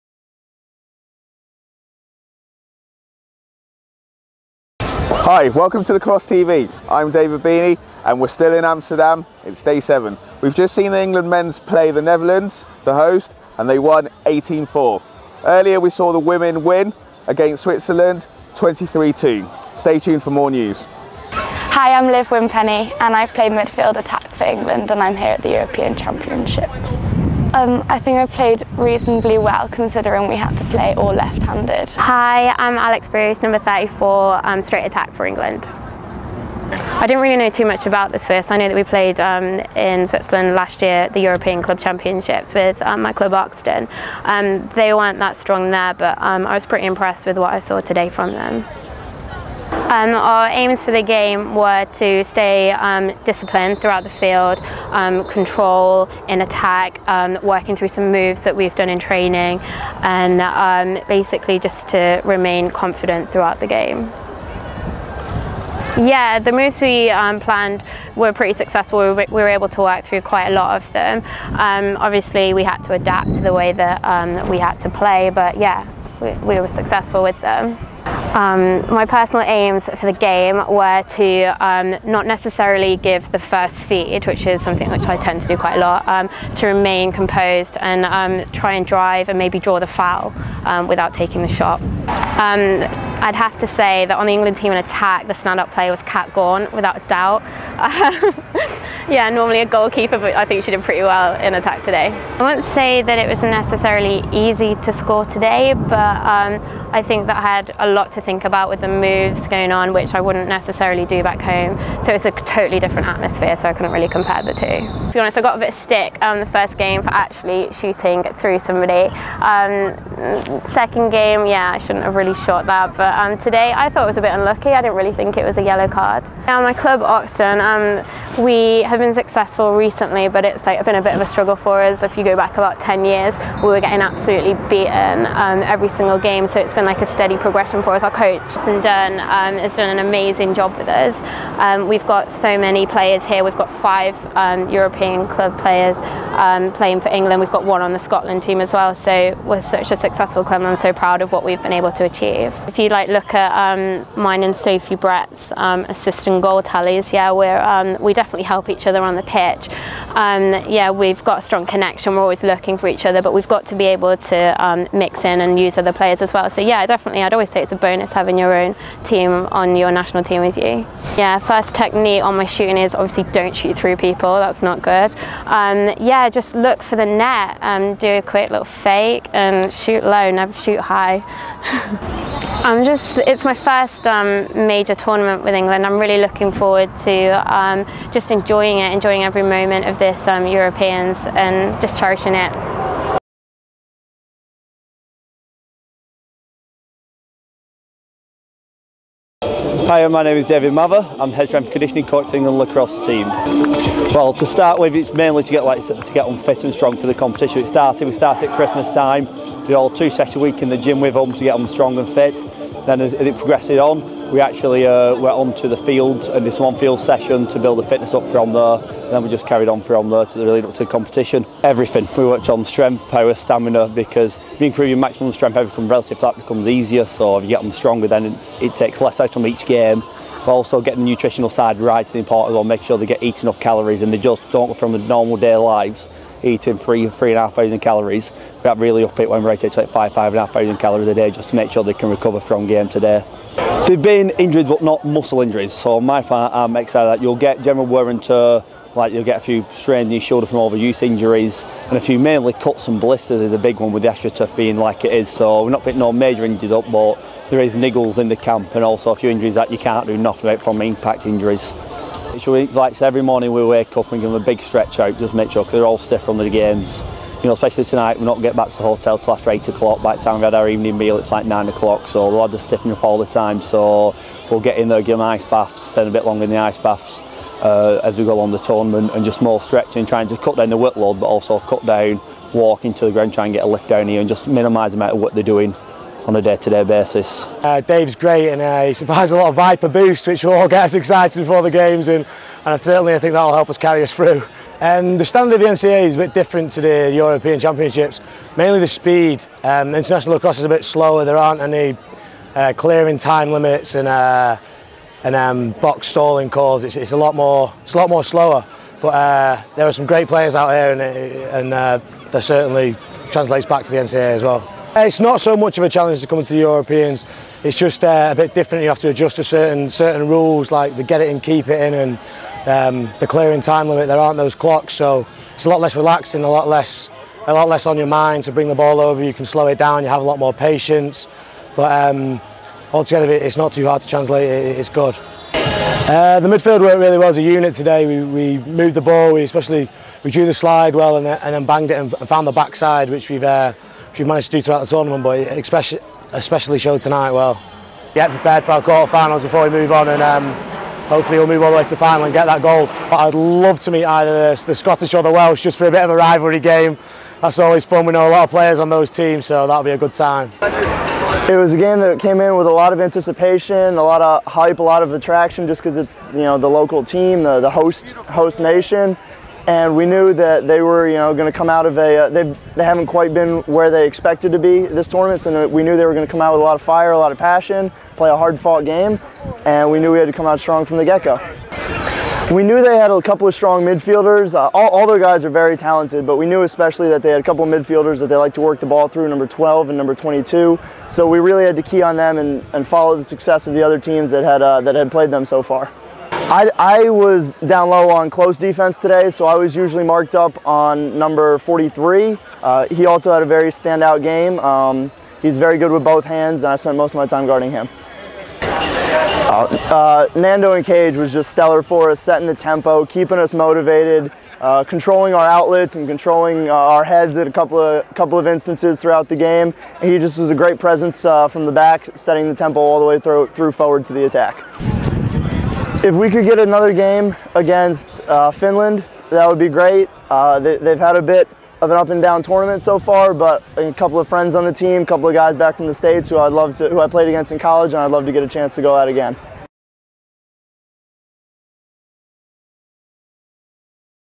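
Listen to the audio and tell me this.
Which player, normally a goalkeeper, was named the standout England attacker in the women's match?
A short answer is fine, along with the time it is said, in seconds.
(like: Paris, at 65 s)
Kat Gorn, at 96 s.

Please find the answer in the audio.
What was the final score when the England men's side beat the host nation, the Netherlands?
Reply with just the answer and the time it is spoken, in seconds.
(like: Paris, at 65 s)
18-4, at 14 s.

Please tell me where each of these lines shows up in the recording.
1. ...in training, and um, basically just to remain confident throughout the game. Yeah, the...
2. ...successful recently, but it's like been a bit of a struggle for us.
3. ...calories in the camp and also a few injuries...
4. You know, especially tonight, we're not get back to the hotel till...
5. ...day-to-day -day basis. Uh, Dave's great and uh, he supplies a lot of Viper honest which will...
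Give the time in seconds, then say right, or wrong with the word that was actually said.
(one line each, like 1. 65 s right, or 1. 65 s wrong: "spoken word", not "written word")
1. 58 s right
2. 129 s right
3. 257 s wrong: "niggles", not "calories"
4. 267 s right
5. 286 s wrong: "boost", not "honest".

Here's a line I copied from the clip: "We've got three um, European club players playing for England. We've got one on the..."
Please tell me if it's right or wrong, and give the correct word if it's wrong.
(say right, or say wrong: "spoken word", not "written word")
wrong: "five", not "three".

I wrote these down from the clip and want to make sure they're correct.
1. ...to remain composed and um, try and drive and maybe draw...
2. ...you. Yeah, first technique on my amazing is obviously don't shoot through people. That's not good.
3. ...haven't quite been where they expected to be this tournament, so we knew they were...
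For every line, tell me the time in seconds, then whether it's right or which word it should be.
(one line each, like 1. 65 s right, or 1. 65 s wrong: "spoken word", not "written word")
1. 86 s right
2. 170 s wrong: "shooting", not "amazing"
3. 372 s right.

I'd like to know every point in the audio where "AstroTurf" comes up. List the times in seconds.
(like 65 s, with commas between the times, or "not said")
254 s.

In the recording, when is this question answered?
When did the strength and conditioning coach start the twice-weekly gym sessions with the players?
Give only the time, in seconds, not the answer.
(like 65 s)
208 s.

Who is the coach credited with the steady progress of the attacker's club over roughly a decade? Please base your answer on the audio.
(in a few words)
Jason Dunn.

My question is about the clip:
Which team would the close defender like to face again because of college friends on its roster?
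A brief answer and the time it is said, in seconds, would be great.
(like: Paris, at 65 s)
Finland, at 428 s.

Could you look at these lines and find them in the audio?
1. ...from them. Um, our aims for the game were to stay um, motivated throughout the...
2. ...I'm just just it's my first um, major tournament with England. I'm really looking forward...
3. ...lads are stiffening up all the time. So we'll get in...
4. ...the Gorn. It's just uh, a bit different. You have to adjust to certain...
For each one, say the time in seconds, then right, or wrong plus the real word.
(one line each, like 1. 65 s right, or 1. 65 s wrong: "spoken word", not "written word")
1. 48 s wrong: "disciplined", not "motivated"
2. 182 s right
3. 272 s right
4. 316 s wrong: "Europeans", not "Gorn".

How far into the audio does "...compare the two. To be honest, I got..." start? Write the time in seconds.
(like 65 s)
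114 s.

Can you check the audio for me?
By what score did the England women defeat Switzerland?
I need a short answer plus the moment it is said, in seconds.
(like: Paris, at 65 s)
23-2, at 18 s.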